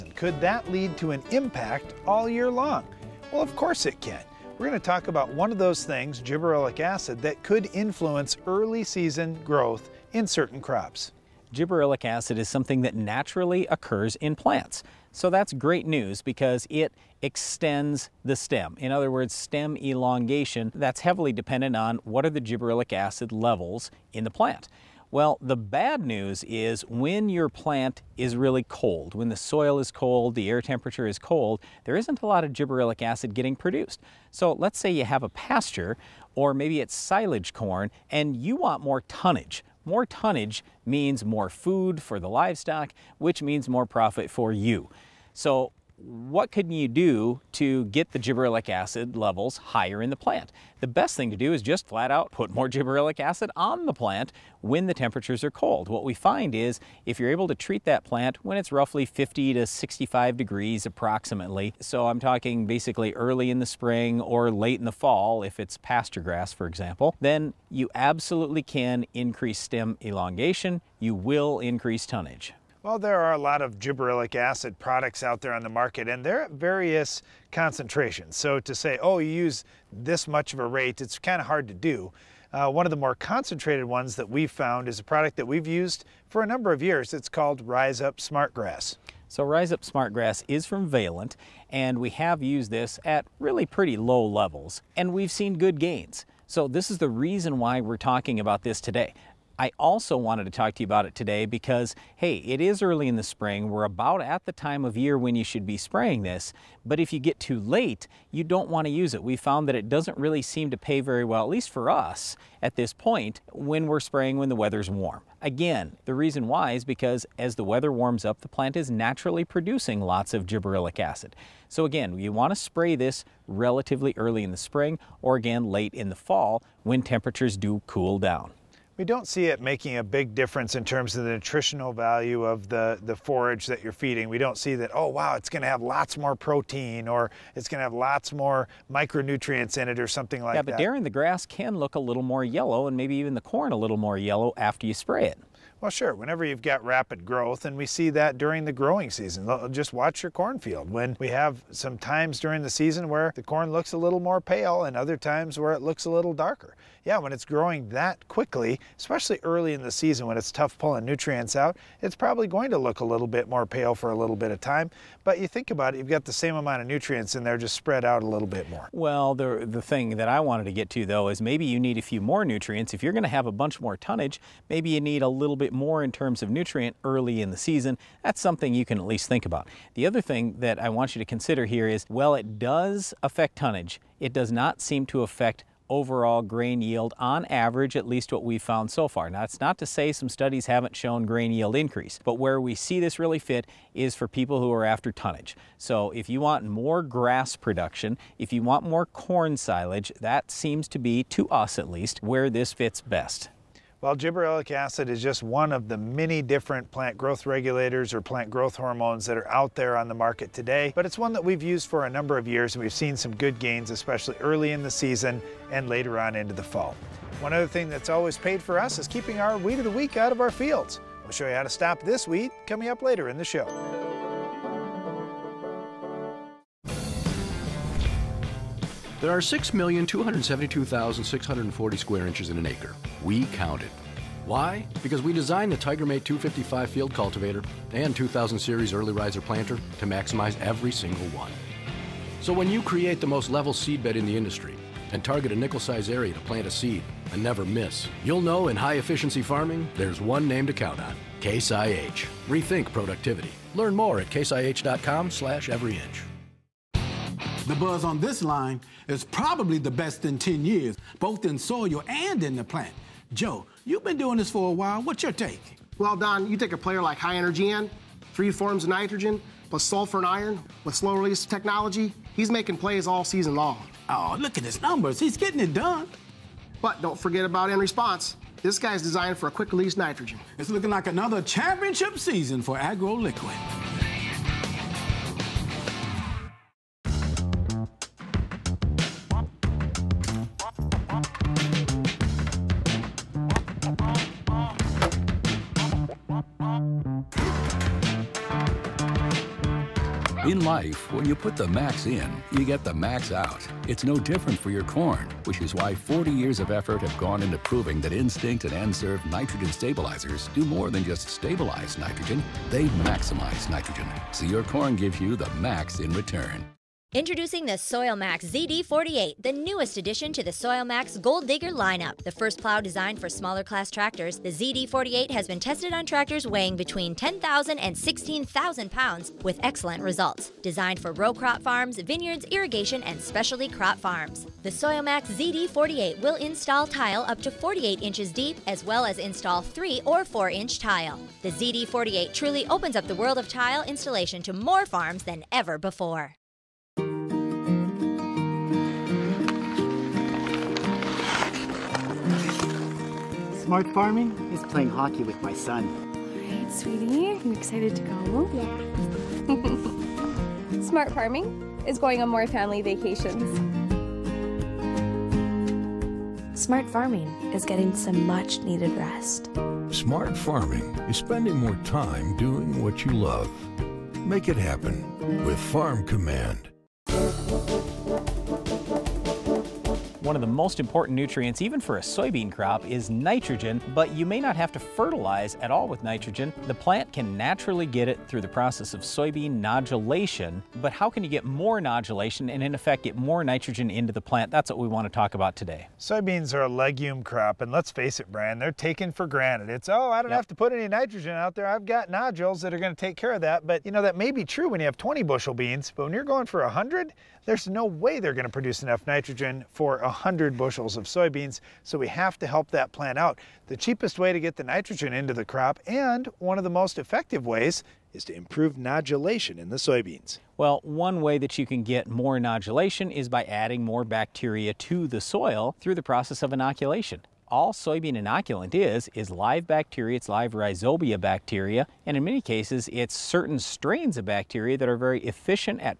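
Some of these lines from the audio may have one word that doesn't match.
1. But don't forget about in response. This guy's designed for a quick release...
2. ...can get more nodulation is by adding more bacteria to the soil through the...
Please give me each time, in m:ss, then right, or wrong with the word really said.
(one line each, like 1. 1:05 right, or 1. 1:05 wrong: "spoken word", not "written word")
1. 4:36 right
2. 7:01 right.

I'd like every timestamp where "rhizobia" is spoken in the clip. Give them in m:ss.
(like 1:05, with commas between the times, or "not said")
7:10.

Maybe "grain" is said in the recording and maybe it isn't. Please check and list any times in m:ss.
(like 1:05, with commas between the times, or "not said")
3:06, 3:11.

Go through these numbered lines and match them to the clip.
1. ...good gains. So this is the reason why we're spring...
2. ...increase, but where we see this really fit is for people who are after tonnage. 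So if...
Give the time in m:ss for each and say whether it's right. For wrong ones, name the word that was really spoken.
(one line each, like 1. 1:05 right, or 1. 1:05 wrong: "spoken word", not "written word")
1. 1:35 wrong: "talking", not "spring"
2. 3:11 right.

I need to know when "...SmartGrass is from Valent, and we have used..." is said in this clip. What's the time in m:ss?
1:29.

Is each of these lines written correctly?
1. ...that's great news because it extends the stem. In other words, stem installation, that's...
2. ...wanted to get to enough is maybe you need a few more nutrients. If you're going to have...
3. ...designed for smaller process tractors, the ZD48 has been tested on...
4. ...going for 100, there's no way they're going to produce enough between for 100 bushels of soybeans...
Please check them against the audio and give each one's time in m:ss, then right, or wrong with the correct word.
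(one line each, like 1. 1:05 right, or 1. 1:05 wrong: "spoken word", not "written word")
1. 0:15 wrong: "elongation", not "installation"
2. 2:50 wrong: "though", not "enough"
3. 5:22 wrong: "class", not "process"
4. 6:46 wrong: "nitrogen", not "between".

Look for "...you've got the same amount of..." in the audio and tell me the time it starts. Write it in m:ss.
2:45.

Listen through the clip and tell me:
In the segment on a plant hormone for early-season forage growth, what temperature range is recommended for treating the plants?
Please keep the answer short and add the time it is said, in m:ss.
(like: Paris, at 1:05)
50 to 65 degrees, at 0:59.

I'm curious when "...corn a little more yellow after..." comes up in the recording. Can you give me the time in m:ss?
2:23.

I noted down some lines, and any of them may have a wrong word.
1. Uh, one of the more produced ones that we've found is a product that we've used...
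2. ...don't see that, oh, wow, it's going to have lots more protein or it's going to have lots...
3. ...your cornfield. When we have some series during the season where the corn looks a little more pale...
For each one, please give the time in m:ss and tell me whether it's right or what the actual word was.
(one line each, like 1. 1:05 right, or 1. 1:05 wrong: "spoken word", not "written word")
1. 1:22 wrong: "concentrated", not "produced"
2. 2:14 right
3. 2:30 wrong: "times", not "series".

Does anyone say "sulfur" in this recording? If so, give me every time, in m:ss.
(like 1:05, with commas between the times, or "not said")
4:29.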